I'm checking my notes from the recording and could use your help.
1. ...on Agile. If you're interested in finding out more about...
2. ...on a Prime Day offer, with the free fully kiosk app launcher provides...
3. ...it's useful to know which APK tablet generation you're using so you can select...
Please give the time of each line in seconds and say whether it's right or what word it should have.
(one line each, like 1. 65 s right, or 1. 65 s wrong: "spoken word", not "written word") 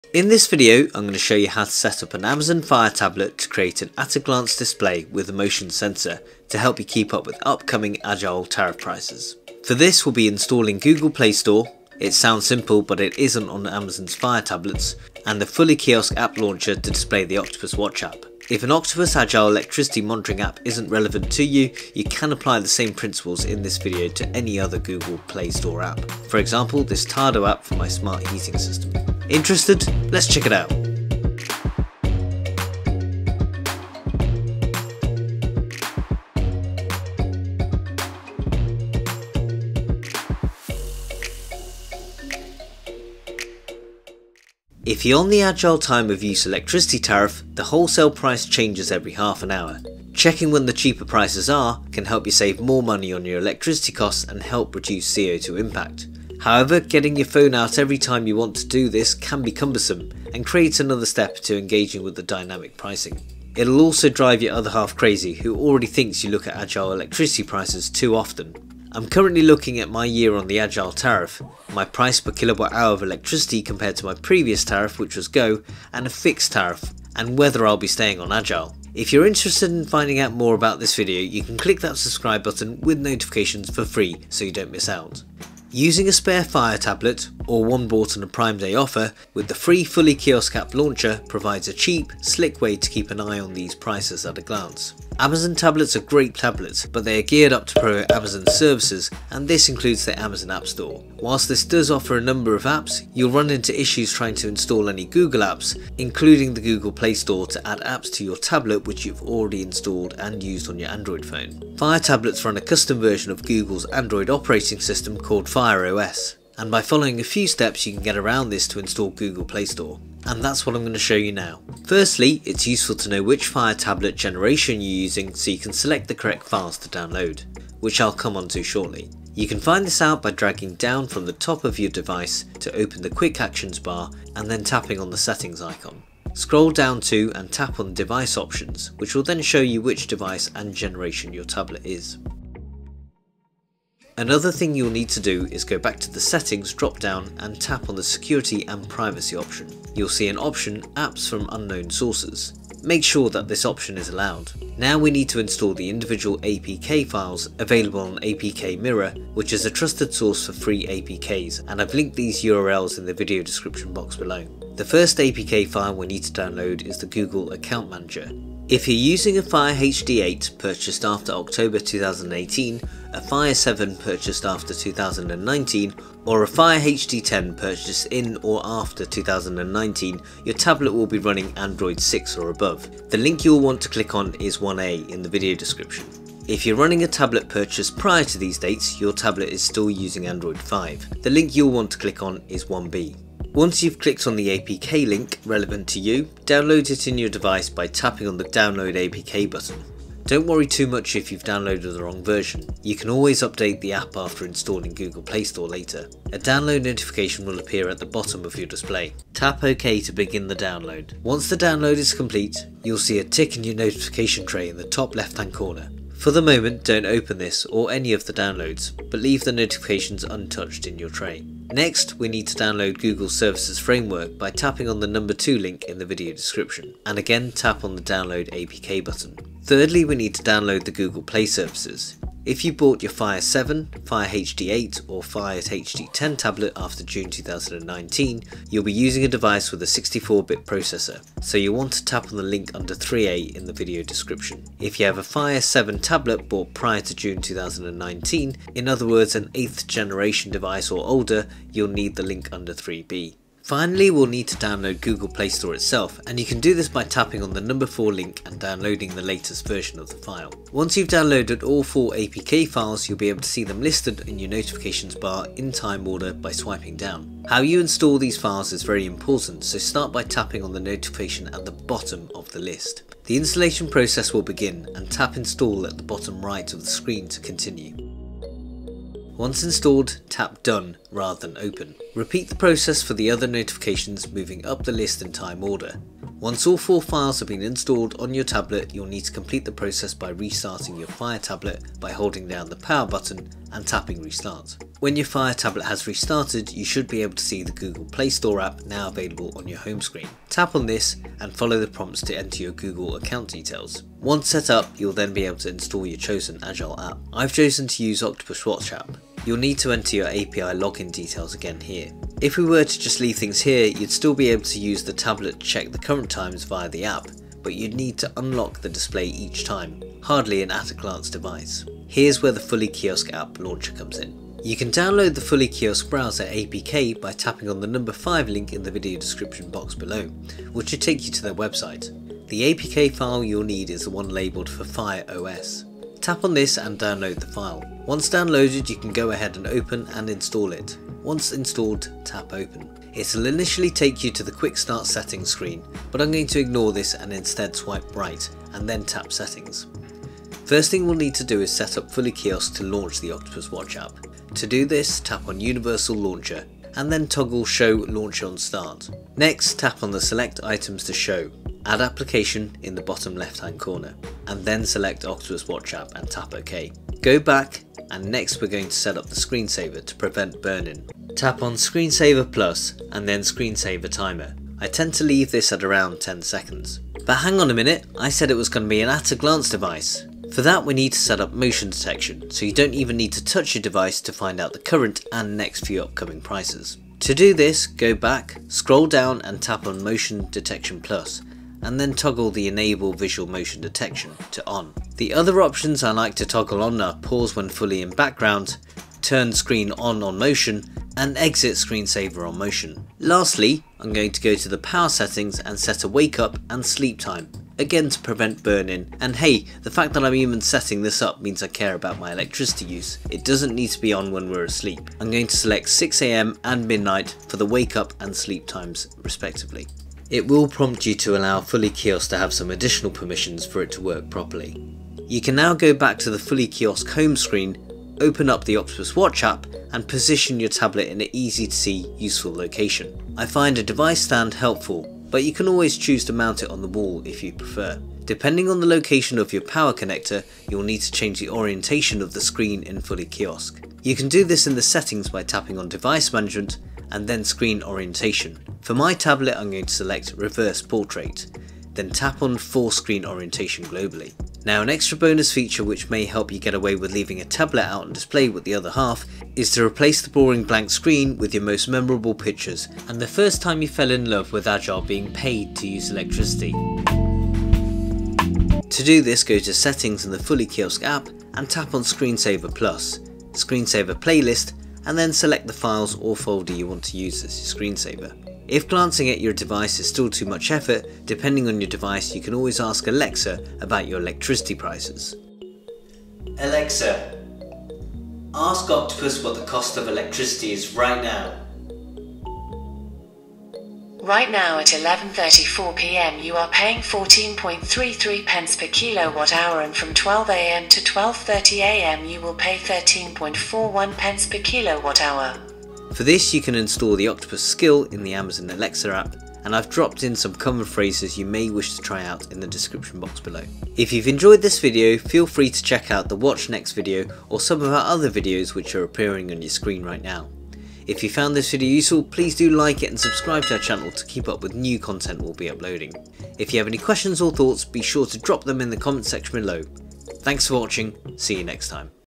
1. 78 s right
2. 88 s right
3. 122 s wrong: "Fire", not "APK".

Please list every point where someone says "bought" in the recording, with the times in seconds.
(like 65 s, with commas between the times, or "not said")
87 s, 232 s, 246 s.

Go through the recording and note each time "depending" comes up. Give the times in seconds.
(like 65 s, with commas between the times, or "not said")
438 s, 481 s.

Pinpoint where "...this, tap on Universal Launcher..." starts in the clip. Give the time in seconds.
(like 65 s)
354 s.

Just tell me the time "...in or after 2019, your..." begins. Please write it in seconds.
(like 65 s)
178 s.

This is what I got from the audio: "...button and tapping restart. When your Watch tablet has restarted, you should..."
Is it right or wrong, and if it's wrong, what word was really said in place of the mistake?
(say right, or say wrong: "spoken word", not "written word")
wrong: "Fire", not "Watch".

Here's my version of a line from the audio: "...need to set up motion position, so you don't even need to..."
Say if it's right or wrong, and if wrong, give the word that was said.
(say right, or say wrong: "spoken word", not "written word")
wrong: "detection", not "position".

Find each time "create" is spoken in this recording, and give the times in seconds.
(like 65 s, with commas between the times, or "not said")
3 s, 60 s.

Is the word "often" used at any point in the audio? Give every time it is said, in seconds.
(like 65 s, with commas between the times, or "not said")
68 s.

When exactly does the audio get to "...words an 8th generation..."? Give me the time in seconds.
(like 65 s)
249 s.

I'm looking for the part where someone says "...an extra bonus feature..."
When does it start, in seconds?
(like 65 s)
454 s.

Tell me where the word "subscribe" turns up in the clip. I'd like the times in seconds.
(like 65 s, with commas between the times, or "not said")
81 s, 523 s.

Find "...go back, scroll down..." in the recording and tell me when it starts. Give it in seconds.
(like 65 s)
387 s.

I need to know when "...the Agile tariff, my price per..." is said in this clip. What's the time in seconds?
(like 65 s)
70 s.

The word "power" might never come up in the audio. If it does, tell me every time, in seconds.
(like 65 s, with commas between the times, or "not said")
292 s, 404 s, 439 s.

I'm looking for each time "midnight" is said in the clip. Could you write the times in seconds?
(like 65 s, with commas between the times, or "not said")
416 s.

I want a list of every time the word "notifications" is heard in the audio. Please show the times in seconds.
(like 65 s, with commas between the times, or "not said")
82 s, 206 s, 213 s, 219 s, 264 s, 270 s, 283 s.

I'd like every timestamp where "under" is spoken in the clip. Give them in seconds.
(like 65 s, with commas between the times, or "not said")
242 s, 252 s.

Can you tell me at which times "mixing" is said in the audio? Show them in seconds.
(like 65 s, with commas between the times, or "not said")
not said.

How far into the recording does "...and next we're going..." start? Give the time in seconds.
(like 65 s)
368 s.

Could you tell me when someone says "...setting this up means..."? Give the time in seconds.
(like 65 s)
410 s.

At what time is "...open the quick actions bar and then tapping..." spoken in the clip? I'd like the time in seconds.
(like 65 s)
132 s.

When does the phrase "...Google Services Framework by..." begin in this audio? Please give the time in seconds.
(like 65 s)
222 s.